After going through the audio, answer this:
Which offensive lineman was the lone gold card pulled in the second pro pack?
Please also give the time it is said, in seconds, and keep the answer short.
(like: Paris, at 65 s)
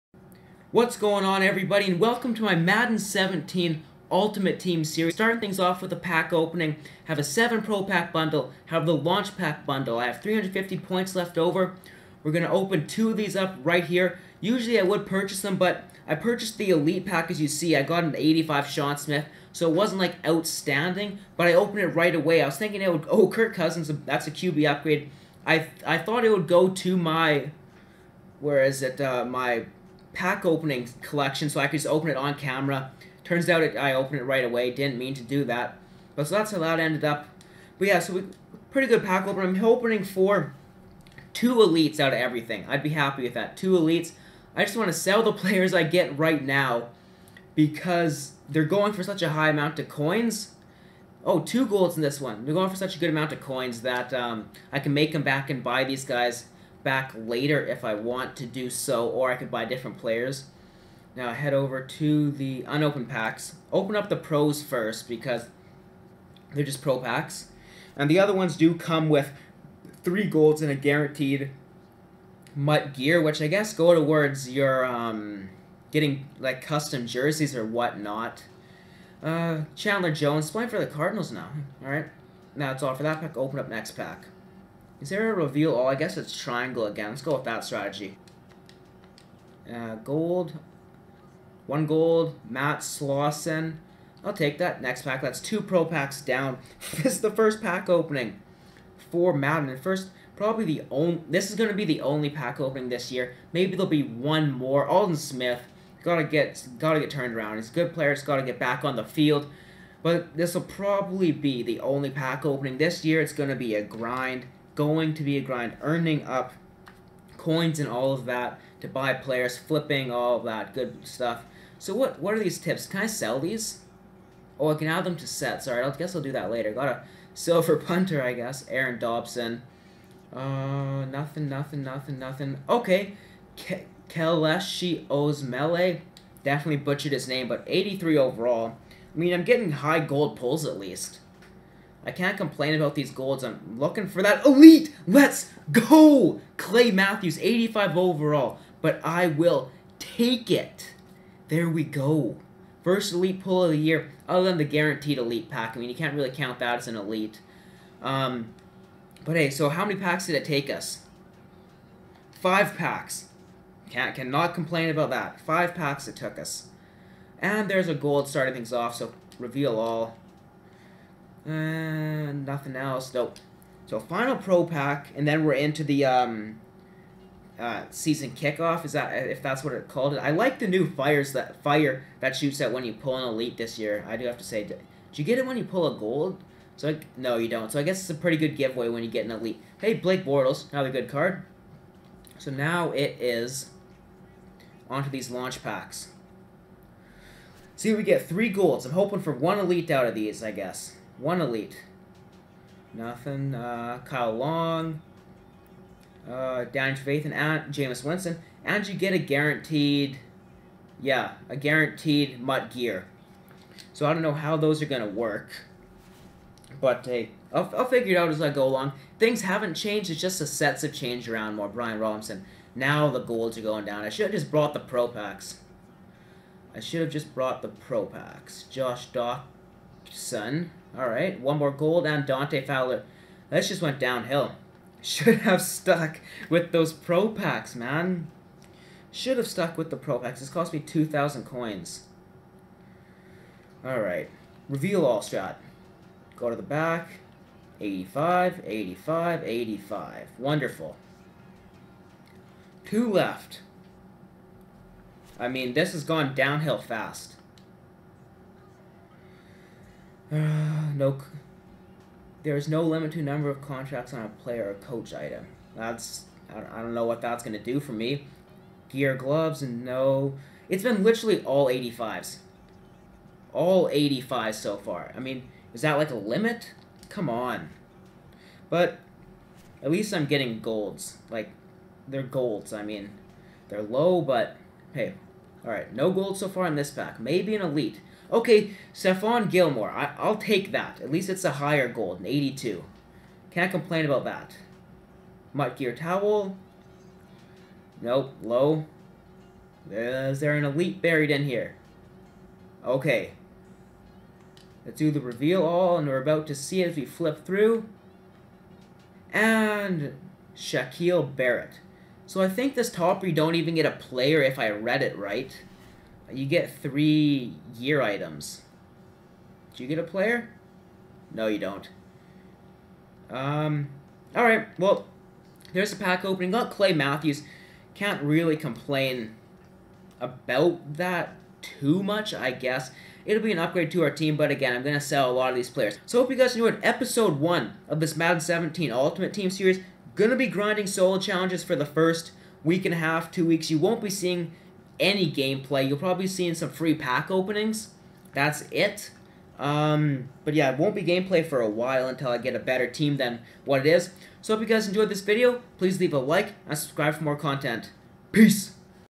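Matt Slauson, at 92 s.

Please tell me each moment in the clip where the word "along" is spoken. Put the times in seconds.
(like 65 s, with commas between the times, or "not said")
218 s.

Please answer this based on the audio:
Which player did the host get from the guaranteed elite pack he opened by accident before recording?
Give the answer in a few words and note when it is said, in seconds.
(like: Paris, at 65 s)
Sean Smith, at 18 s.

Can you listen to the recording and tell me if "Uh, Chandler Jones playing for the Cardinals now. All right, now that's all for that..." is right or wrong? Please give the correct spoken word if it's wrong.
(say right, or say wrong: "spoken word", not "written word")
right.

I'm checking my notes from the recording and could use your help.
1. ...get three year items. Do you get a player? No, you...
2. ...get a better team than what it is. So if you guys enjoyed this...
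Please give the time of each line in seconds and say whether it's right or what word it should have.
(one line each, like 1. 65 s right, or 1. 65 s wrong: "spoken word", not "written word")
1. 316 s right
2. 352 s right.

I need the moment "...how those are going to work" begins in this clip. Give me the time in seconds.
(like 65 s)
214 s.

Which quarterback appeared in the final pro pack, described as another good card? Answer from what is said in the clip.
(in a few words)
Blake Bortles.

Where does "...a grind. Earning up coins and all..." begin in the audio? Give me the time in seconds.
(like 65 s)
115 s.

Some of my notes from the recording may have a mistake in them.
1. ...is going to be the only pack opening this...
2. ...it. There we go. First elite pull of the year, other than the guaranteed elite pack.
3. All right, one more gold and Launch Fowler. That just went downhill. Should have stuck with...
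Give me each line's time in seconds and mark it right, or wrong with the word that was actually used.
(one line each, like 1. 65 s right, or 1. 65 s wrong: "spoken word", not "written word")
1. 101 s right
2. 150 s right
3. 230 s wrong: "Dante", not "Launch".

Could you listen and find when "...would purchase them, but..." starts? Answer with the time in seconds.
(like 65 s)
14 s.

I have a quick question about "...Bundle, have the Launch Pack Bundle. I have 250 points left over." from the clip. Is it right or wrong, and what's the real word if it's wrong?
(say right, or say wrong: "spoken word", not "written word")
wrong: "350", not "250".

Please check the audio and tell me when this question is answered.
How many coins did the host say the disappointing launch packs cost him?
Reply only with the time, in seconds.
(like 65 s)
240 s.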